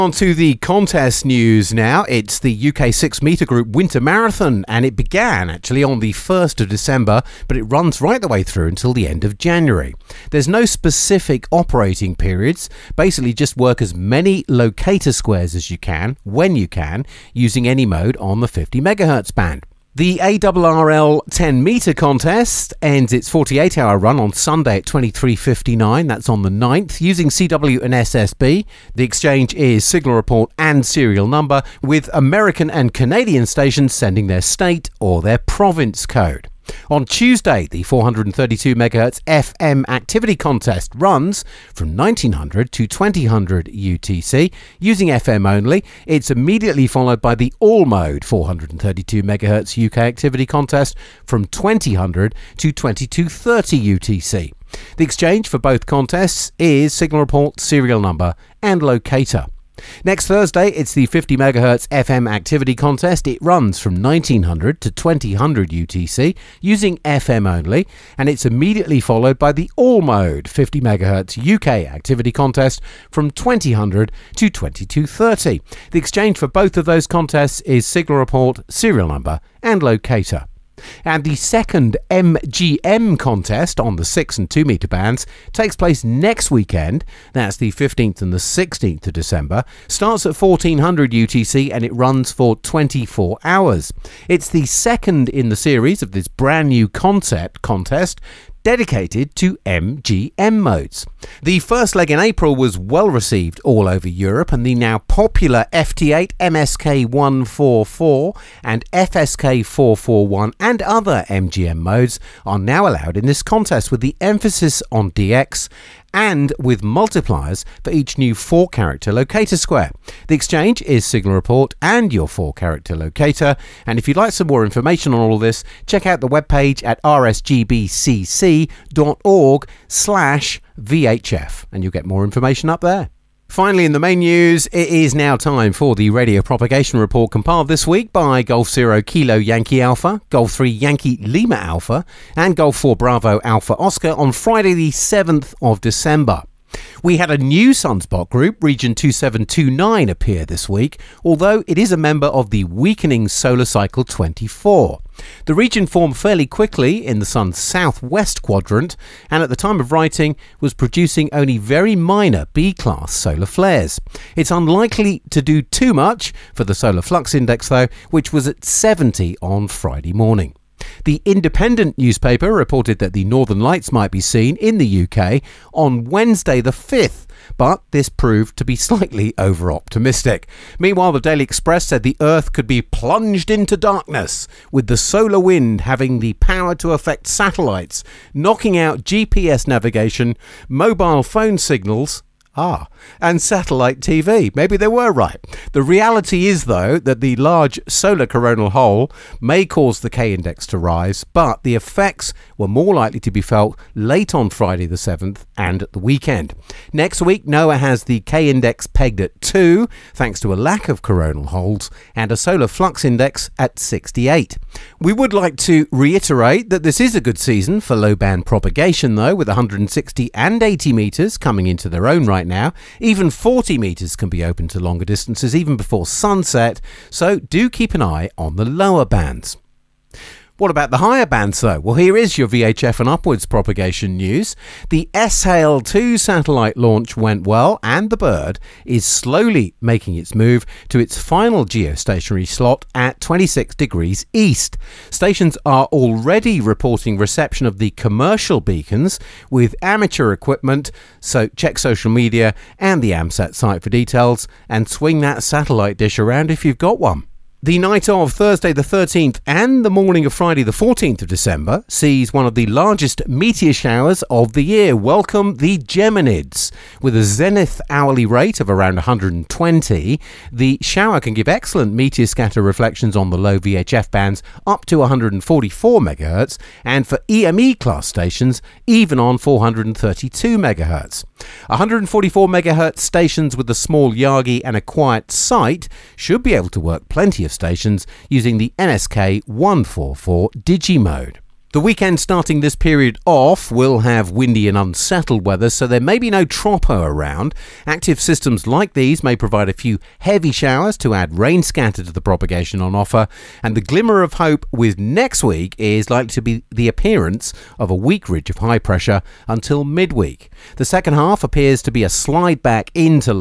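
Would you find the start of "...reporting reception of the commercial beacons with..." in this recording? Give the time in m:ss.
4:06.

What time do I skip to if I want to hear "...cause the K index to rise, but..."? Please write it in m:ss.
3:19.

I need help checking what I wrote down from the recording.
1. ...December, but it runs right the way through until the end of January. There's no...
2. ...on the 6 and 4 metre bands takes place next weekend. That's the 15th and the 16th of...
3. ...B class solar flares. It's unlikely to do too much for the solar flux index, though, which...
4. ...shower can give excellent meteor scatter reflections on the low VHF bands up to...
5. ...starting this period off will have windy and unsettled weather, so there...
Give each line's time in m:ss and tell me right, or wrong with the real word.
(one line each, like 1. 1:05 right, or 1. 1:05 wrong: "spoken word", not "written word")
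1. 0:06 right
2. 1:23 wrong: "2", not "4"
3. 2:42 right
4. 4:30 right
5. 4:52 right.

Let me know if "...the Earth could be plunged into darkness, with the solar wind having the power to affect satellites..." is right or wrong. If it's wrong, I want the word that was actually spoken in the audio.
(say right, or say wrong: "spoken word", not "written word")
right.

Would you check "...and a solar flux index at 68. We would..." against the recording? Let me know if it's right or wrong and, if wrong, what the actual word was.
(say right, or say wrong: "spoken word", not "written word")
right.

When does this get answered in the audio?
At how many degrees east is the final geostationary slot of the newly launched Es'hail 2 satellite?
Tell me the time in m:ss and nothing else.
4:03.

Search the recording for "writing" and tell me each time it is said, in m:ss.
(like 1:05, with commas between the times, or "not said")
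2:39.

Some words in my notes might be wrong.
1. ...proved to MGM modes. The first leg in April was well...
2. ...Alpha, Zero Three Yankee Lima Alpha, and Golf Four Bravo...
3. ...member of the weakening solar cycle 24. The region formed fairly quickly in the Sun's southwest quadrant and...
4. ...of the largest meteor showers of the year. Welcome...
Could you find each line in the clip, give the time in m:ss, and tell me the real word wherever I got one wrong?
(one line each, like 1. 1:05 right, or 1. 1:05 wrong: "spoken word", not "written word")
1. 1:38 wrong: "dedicated", not "proved"
2. 2:19 wrong: "Golf", not "Zero"
3. 2:31 right
4. 4:22 right.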